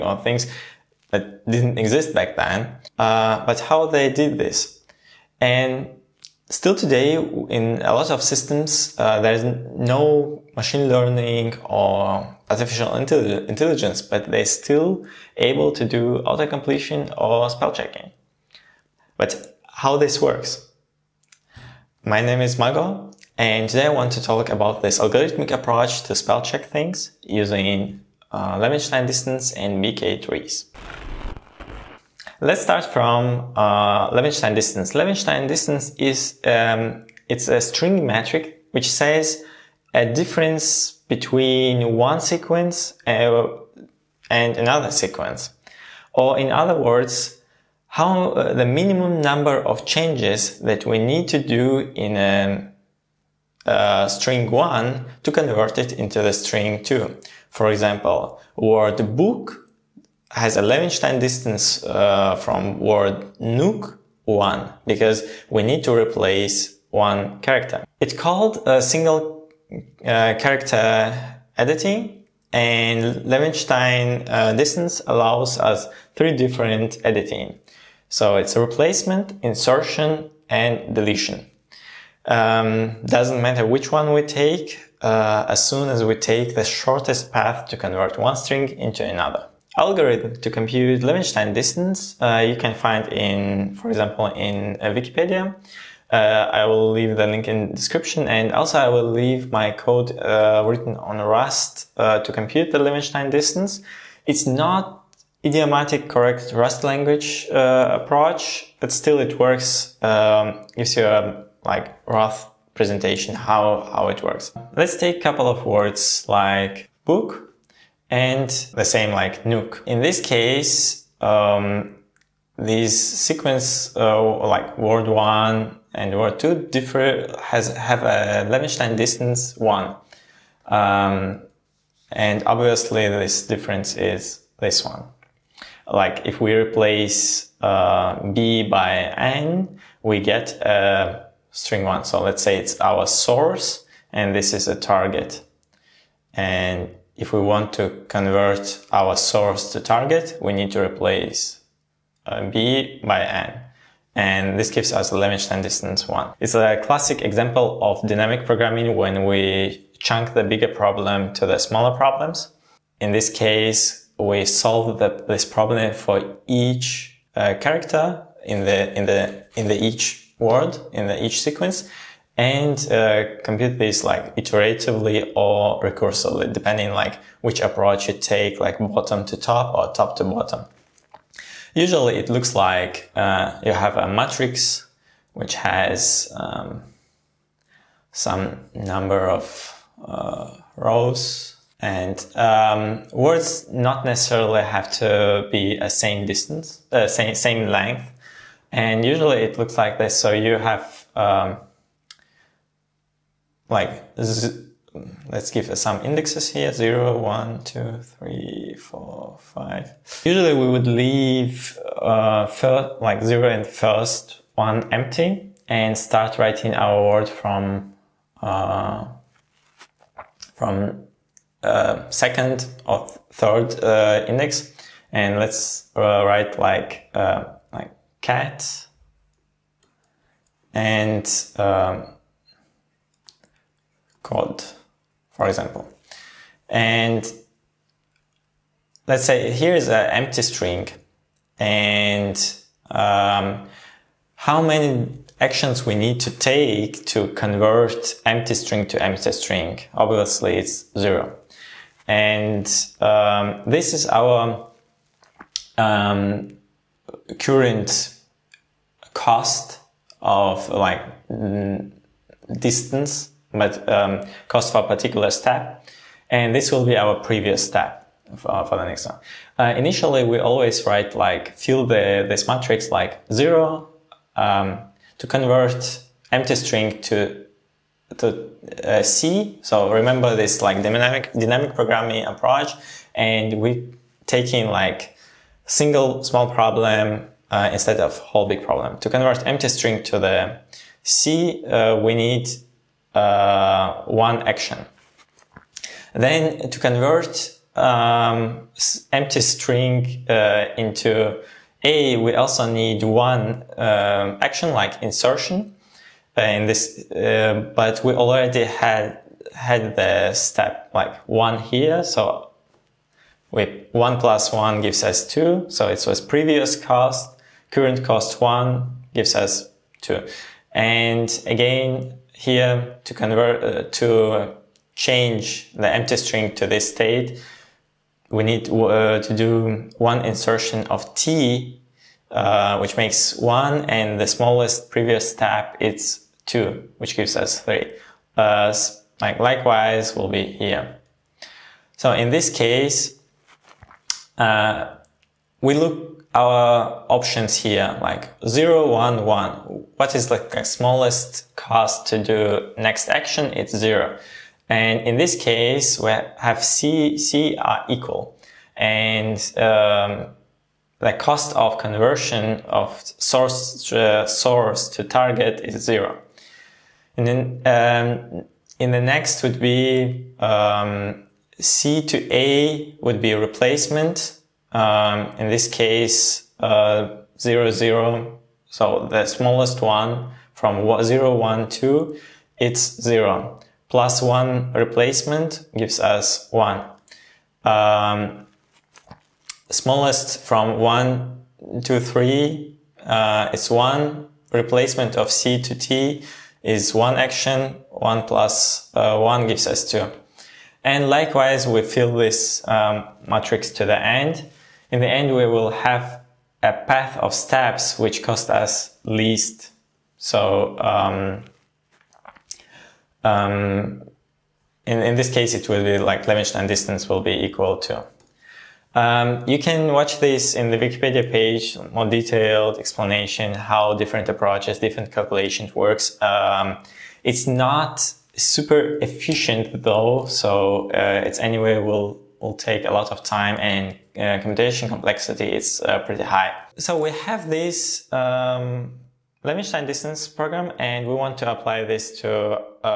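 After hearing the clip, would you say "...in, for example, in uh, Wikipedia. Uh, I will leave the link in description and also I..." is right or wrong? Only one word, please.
right.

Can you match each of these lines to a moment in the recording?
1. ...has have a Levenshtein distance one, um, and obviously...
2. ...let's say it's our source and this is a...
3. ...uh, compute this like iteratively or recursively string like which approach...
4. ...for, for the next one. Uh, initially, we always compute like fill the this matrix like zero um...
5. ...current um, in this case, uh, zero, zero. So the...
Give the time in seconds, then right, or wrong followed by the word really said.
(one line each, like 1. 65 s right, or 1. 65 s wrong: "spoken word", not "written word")
1. 127 s right
2. 142 s right
3. 172 s wrong: "depending", not "string"
4. 268 s wrong: "write", not "compute"
5. 373 s wrong: "replacement", not "current".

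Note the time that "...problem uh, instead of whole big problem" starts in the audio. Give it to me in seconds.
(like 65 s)
286 s.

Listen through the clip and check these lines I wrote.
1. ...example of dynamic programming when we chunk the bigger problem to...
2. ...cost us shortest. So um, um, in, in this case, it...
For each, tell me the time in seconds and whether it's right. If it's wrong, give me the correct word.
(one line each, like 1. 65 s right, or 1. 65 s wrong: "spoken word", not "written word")
1. 157 s right
2. 408 s wrong: "least", not "shortest".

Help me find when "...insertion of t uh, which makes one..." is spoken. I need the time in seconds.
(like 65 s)
330 s.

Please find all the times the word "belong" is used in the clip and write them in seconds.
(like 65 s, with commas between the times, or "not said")
not said.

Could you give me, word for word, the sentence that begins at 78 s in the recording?
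So it's replacement, insertion and deletion.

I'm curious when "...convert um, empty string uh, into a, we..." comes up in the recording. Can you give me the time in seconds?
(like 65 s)
296 s.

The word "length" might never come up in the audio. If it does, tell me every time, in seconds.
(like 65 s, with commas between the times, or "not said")
197 s.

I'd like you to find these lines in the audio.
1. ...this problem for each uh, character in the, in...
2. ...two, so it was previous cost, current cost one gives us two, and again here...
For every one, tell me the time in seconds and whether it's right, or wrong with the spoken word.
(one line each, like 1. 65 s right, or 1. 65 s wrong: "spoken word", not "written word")
1. 165 s right
2. 315 s right.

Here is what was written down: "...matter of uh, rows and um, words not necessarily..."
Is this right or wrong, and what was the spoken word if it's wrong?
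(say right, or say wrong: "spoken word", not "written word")
wrong: "number", not "matter".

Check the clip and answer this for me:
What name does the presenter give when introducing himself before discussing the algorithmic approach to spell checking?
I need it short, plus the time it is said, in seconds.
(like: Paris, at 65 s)
Mago, at 22 s.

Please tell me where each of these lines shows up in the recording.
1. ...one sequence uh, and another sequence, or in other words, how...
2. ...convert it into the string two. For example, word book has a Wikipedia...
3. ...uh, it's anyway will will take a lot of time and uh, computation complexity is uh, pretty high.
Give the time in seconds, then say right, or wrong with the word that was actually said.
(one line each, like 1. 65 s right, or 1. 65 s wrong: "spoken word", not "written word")
1. 41 s right
2. 55 s wrong: "Levenshtein", not "Wikipedia"
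3. 430 s right.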